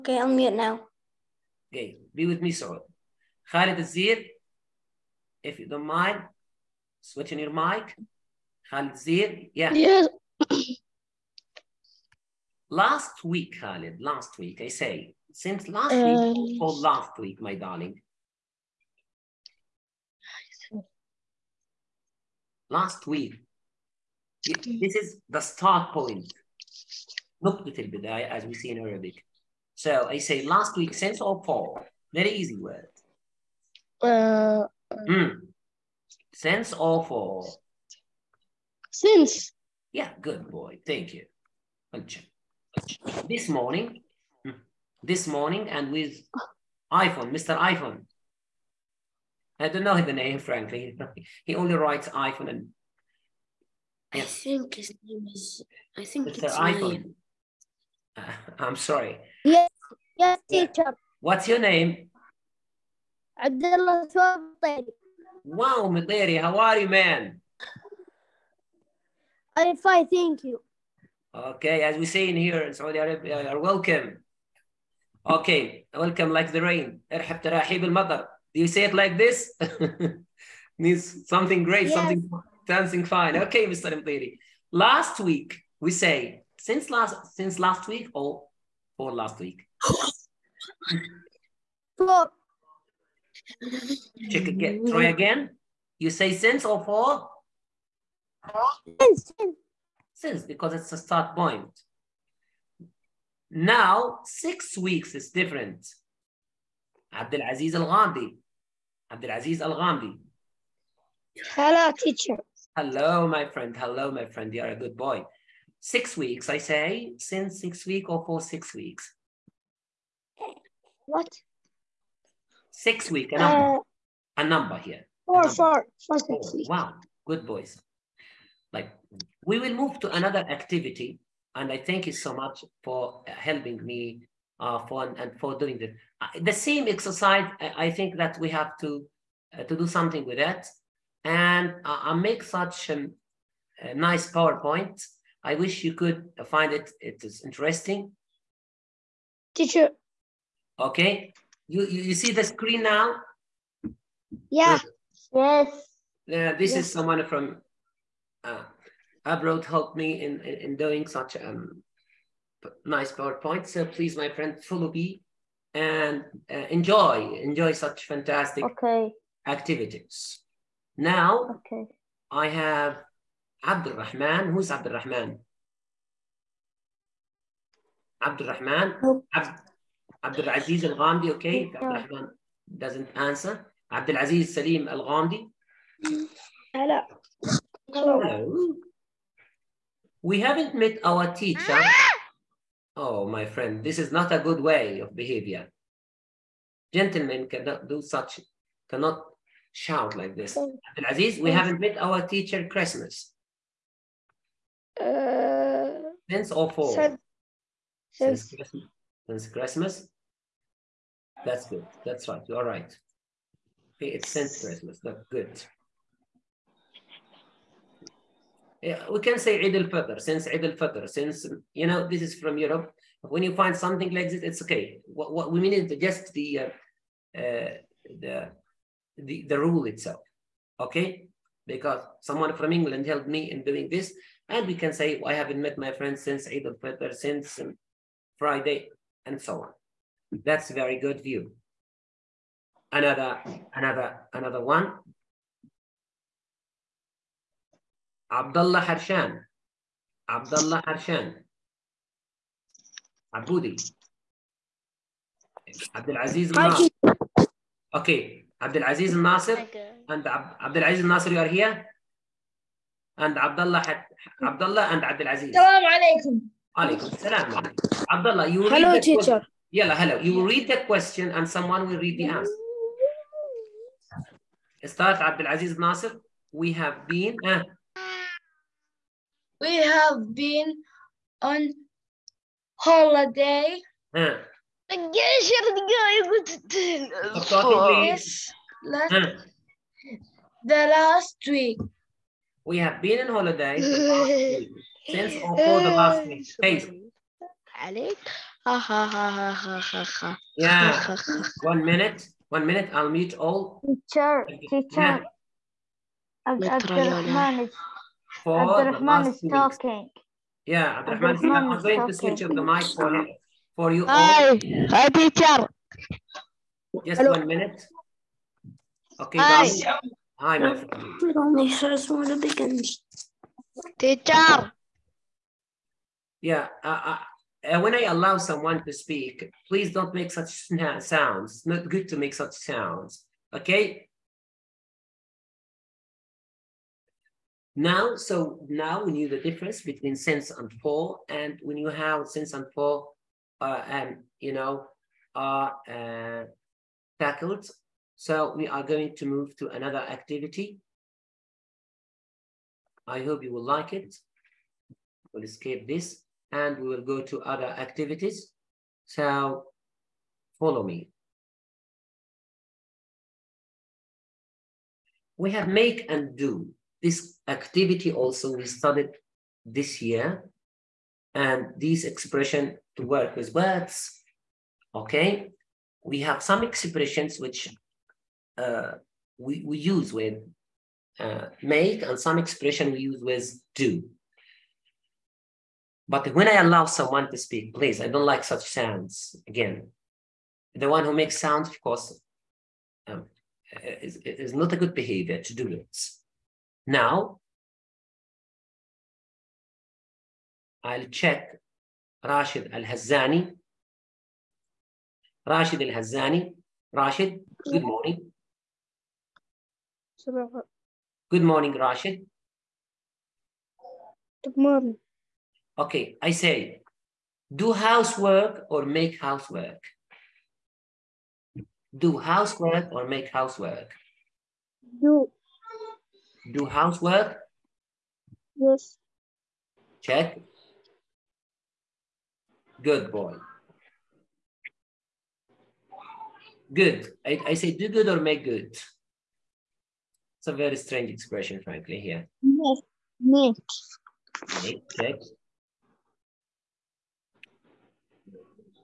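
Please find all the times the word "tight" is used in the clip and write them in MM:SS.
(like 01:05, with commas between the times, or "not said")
not said.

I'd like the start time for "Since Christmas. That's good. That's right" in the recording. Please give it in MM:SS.
03:29.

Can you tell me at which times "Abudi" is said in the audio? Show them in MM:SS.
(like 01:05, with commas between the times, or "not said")
04:13.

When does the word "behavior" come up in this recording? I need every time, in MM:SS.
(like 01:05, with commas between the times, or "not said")
03:15, 06:34.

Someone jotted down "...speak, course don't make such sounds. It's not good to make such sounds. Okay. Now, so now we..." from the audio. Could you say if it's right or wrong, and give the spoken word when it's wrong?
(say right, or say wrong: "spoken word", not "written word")
wrong: "please", not "course".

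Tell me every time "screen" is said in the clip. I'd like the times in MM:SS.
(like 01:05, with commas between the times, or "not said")
02:32.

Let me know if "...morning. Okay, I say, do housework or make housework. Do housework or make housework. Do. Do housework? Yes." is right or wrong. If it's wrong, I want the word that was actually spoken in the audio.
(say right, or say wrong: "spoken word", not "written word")
right.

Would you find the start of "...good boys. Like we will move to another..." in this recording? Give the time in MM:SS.
02:07.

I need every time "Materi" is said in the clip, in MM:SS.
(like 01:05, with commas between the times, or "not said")
01:05, 01:23.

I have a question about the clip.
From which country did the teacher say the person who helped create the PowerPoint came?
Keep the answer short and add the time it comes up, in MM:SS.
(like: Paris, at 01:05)
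England, at 03:52.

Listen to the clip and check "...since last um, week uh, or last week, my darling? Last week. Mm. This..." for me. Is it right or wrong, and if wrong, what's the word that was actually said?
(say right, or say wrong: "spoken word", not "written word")
right.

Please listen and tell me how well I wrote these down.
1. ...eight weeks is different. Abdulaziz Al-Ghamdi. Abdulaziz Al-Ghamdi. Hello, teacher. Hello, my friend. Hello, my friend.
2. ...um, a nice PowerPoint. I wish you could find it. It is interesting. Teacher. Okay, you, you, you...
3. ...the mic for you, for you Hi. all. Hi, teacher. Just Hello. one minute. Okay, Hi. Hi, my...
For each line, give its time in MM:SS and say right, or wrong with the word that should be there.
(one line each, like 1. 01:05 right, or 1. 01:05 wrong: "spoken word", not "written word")
1. 01:44 wrong: "six", not "eight"
2. 02:22 right
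3. 05:12 right.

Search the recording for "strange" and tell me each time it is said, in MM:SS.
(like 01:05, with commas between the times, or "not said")
07:20.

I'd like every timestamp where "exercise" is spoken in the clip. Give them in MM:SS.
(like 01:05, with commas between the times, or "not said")
02:16.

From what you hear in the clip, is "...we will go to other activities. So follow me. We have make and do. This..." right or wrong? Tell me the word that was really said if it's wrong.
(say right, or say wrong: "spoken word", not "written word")
right.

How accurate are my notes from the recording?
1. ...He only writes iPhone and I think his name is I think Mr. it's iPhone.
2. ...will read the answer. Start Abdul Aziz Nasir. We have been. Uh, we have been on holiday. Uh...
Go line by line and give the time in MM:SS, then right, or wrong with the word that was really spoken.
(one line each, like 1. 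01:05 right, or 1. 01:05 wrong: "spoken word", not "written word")
1. 00:51 right
2. 04:31 right.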